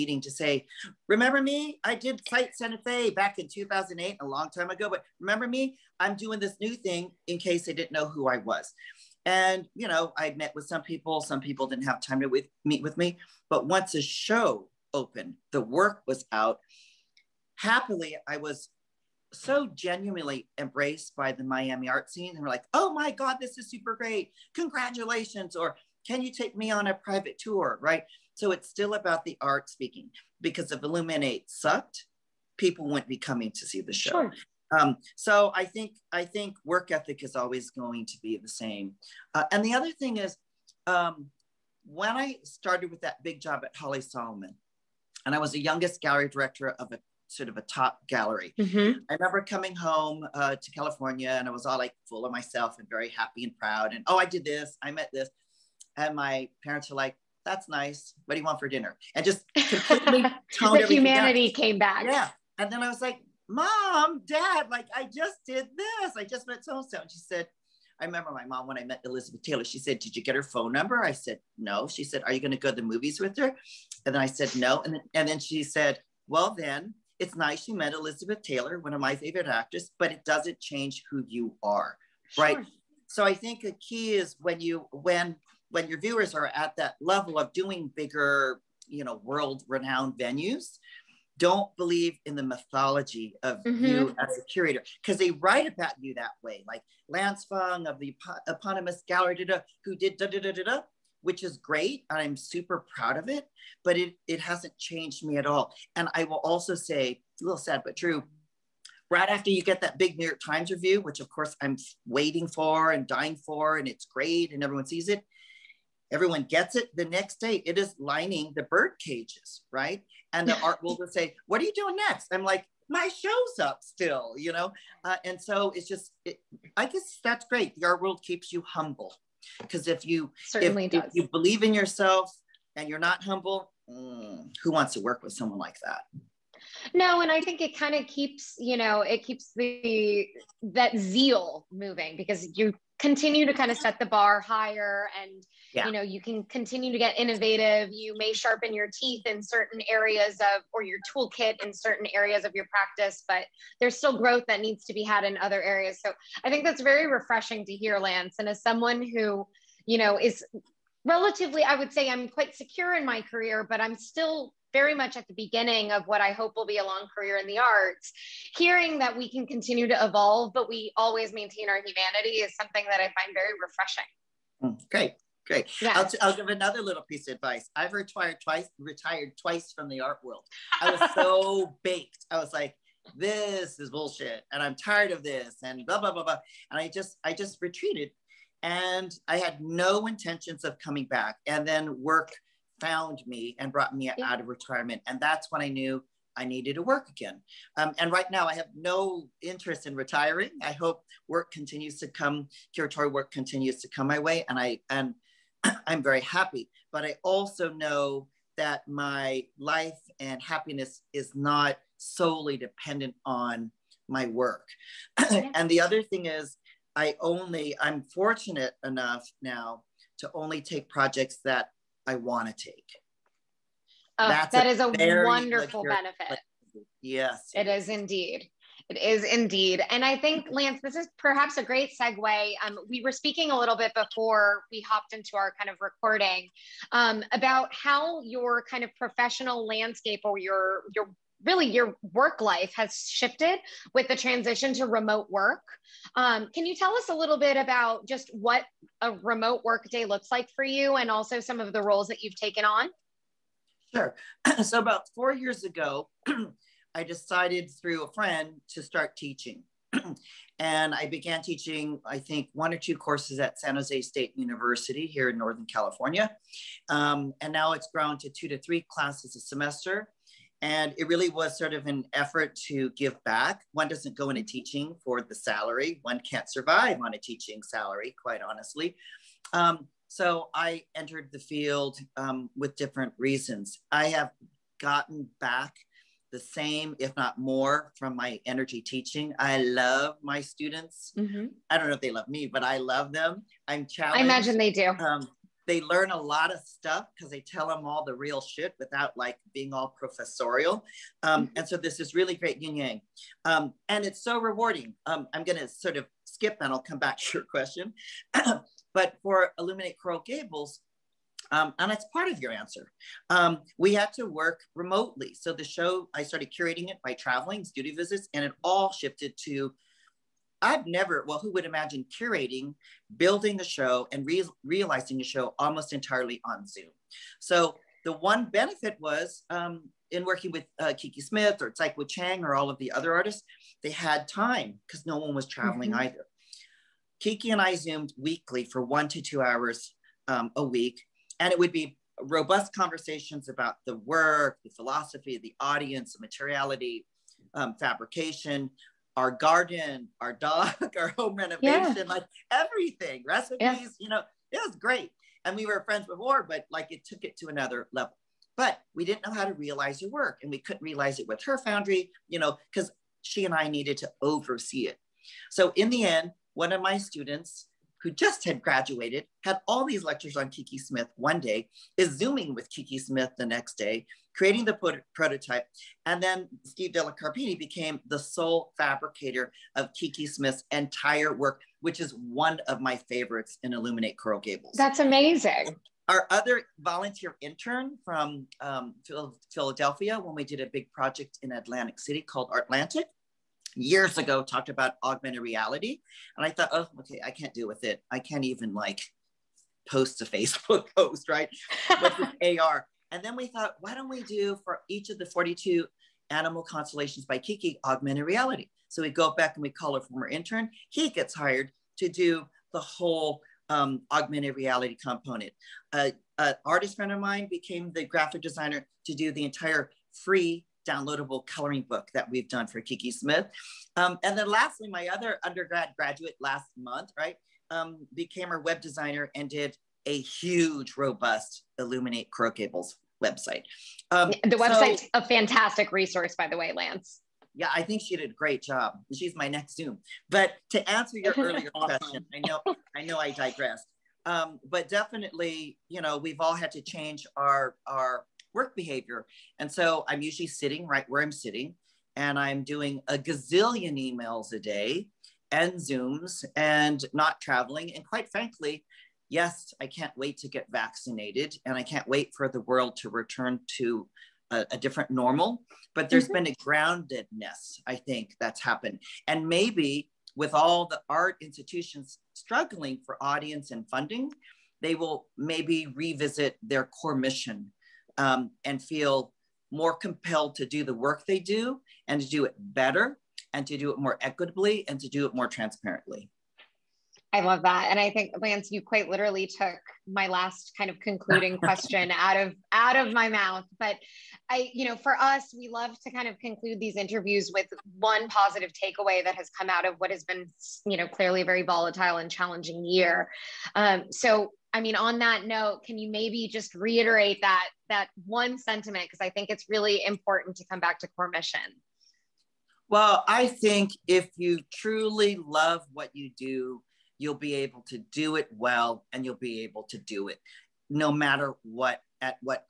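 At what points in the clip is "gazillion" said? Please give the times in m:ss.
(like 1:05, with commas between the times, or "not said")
7:33.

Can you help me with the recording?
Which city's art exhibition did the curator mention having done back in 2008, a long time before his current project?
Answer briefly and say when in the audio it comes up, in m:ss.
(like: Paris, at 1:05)
Santa Fe, at 0:02.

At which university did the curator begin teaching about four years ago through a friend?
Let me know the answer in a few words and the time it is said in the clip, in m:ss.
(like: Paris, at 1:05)
San Jose State University, at 4:23.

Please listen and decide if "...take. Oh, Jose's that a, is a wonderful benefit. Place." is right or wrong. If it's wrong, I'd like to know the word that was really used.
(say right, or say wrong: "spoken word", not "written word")
wrong: "That", not "Jose".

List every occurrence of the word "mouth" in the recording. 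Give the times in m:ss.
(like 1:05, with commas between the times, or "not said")
8:13.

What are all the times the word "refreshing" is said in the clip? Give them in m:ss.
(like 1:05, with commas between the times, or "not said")
2:37, 2:53.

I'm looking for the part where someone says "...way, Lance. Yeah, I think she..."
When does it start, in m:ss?
7:16.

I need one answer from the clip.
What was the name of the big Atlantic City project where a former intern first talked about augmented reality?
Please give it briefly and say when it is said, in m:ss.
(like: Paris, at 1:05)
Artlantic, at 6:32.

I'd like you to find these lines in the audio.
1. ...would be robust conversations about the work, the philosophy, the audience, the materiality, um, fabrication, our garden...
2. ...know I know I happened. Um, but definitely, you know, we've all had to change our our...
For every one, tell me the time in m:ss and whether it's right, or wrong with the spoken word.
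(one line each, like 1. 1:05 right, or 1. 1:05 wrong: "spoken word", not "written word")
1. 5:41 right
2. 7:22 wrong: "digressed", not "happened".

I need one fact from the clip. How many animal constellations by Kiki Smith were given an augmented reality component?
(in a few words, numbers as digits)
42.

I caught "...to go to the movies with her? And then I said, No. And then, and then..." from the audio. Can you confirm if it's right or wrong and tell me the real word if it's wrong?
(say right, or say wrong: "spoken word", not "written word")
right.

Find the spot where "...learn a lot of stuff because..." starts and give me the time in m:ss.
4:55.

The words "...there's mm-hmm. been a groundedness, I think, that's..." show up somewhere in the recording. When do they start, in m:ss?
7:46.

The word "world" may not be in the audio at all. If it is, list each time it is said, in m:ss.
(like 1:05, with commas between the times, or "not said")
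1:29, 2:00, 2:08, 3:00, 7:42.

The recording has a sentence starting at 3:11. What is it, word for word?
And then work found me and brought me yeah.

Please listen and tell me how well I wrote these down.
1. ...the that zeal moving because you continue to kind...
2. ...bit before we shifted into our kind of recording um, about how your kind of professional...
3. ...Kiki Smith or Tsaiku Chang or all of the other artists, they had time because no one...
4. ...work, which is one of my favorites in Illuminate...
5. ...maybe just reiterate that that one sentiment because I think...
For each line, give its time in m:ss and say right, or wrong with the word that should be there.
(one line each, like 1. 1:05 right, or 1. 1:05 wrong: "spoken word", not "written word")
1. 2:19 right
2. 3:53 wrong: "hopped", not "shifted"
3. 5:30 right
4. 6:21 right
5. 8:26 right.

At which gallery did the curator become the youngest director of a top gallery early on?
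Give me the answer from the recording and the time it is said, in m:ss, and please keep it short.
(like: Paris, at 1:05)
Holly Solomon, at 0:43.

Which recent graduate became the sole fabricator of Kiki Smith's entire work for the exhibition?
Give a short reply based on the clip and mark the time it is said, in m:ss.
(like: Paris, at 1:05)
Steve Della Carpini, at 6:16.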